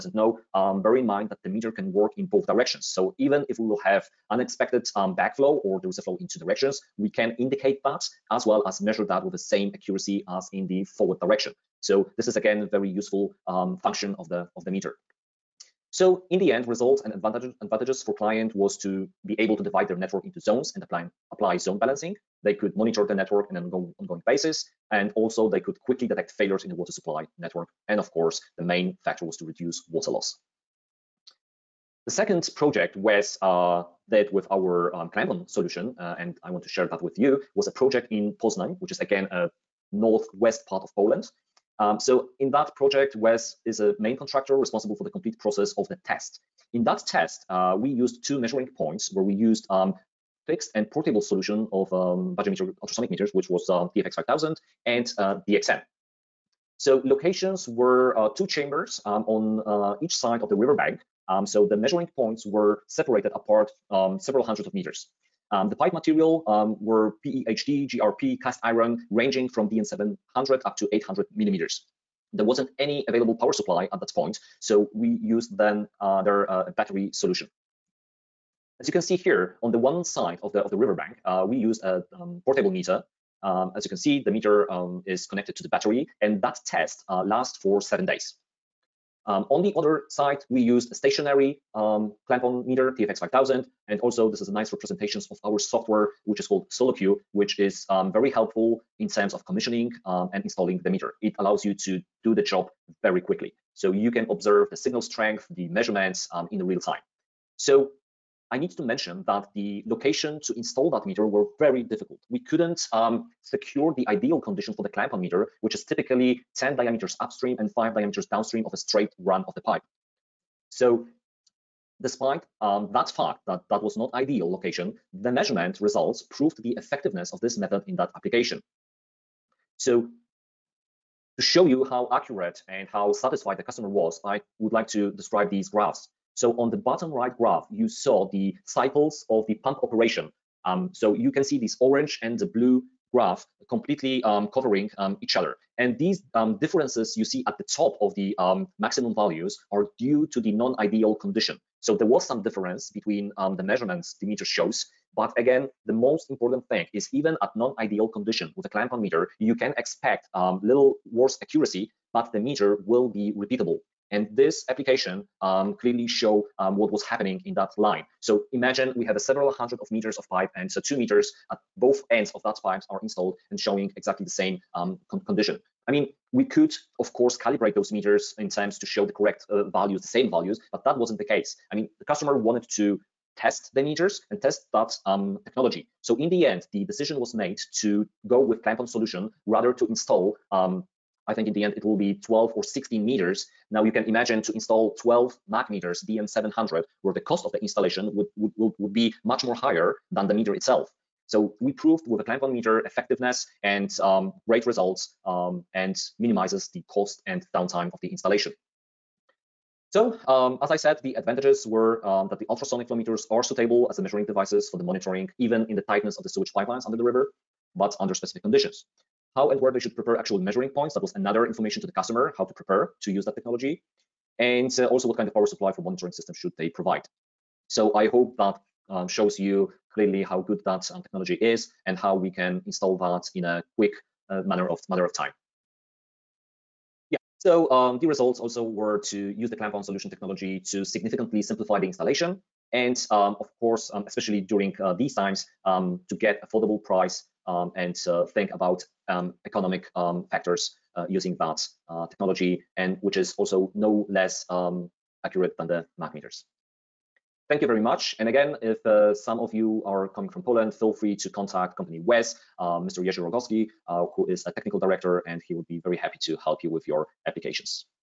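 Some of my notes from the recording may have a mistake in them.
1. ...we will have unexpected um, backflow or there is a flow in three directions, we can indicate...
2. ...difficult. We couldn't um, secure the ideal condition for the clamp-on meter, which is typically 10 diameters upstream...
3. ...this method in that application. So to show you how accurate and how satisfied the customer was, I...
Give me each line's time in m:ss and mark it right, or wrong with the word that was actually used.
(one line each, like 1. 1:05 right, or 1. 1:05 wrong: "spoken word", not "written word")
1. 0:03 wrong: "two", not "three"
2. 1:51 right
3. 2:07 right.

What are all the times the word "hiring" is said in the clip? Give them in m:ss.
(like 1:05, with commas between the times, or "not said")
not said.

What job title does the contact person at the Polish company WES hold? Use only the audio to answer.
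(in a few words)
Technical director.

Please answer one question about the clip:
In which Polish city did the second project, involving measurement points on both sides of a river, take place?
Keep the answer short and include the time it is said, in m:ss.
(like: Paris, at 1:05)
Poznań, at 0:38.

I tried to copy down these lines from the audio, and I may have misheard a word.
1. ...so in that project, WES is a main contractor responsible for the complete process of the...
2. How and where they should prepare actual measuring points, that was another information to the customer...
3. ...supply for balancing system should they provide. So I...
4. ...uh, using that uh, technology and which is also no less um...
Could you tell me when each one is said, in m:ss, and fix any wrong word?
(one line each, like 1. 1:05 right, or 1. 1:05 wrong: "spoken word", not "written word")
1. 0:41 right
2. 3:39 right
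3. 3:45 wrong: "monitoring", not "balancing"
4. 4:10 right.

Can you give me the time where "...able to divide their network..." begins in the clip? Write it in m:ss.
0:19.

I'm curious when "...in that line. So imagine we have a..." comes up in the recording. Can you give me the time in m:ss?
2:47.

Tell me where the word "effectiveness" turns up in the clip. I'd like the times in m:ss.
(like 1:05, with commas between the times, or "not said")
2:06, 3:22.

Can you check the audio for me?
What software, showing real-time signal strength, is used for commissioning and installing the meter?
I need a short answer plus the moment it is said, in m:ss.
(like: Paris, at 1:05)
SoloQ, at 1:36.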